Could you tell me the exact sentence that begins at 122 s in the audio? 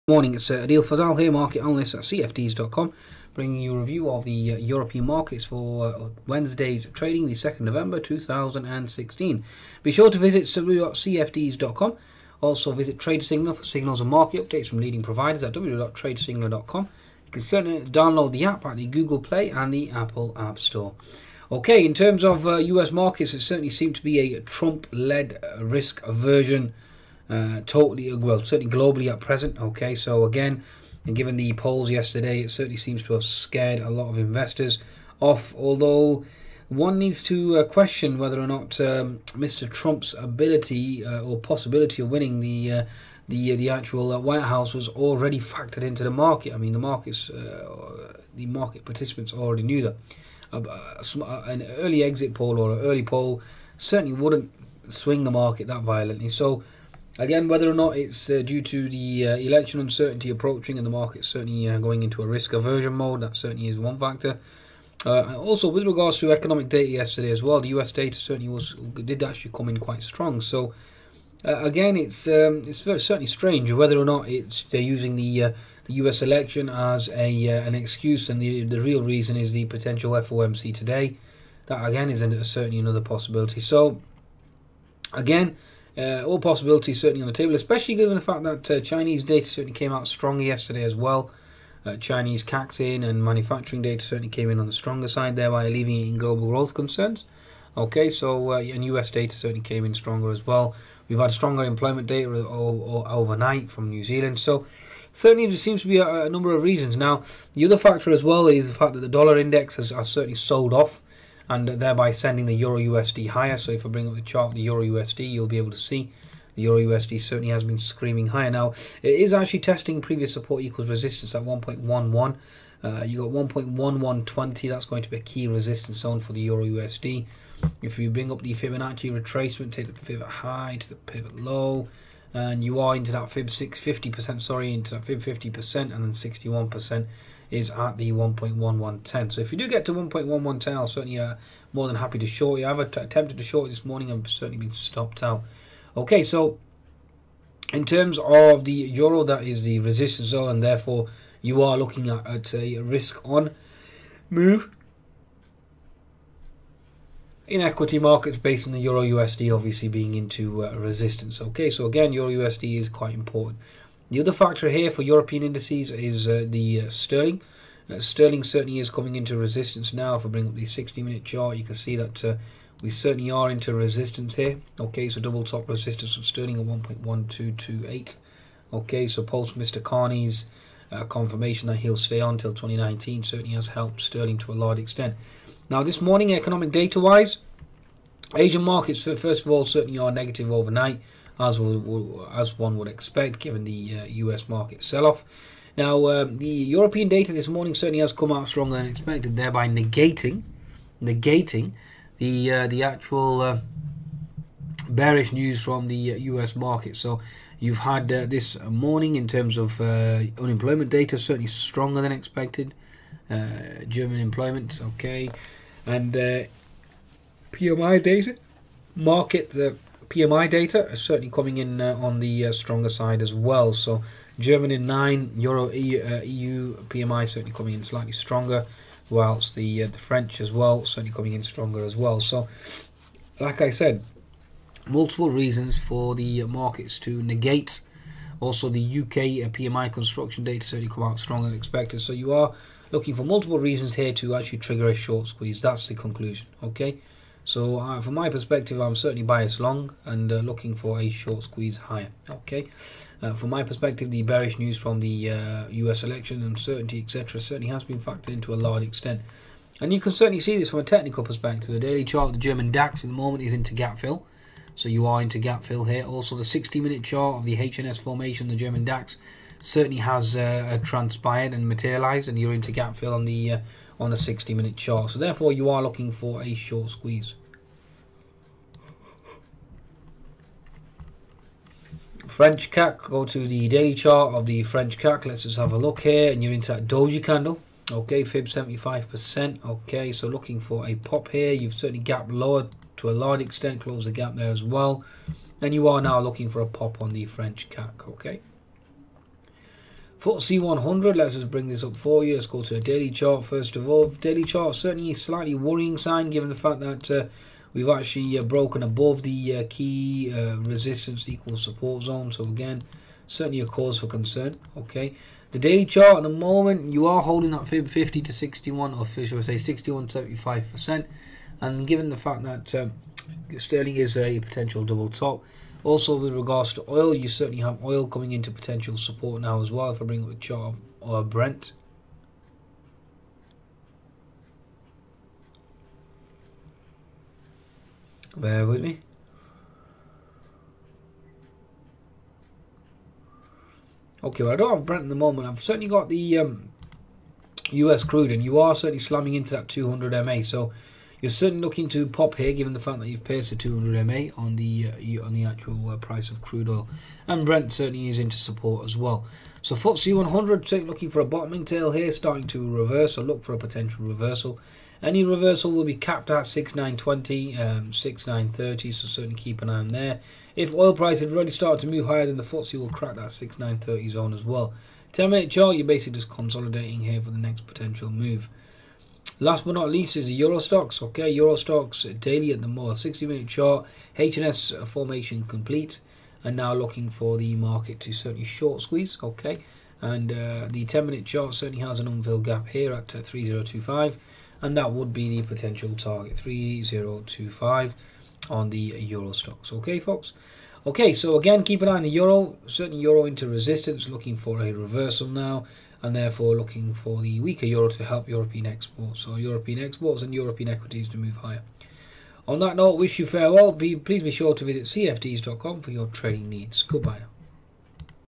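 Uh, you got 1.1120, that's going to be a key resistance zone for the Euro USD.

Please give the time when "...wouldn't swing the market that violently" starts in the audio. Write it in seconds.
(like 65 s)
54 s.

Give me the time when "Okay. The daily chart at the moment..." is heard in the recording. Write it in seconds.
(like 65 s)
314 s.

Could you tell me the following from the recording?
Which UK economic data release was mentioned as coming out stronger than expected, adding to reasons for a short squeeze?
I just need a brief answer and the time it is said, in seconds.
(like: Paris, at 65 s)
PMI construction, at 239 s.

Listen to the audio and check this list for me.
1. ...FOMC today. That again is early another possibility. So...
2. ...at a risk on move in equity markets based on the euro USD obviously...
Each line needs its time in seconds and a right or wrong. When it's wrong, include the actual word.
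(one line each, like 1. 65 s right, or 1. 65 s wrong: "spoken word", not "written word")
1. 80 s wrong: "certainly", not "early"
2. 152 s right.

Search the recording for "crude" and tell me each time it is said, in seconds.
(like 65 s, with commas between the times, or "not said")
348 s, 356 s.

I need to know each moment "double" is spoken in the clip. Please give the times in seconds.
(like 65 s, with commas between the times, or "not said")
175 s, 324 s.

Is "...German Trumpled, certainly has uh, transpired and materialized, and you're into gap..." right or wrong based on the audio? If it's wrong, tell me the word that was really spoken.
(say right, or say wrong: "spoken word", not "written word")
wrong: "DAX", not "Trumpled".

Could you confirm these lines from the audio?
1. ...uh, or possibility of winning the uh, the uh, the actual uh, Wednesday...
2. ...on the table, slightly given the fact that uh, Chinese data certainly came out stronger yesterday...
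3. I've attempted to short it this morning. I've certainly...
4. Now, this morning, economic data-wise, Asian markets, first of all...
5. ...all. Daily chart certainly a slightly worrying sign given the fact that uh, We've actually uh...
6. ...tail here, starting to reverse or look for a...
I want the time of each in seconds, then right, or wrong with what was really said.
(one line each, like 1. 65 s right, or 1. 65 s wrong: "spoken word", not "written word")
1. 41 s wrong: "White", not "Wednesday"
2. 87 s wrong: "especially", not "slightly"
3. 142 s right
4. 185 s right
5. 303 s right
6. 361 s right.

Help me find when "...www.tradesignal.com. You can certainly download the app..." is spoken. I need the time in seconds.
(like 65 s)
15 s.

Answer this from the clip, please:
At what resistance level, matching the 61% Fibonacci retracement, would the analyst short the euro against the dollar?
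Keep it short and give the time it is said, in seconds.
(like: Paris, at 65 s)
1.1110, at 136 s.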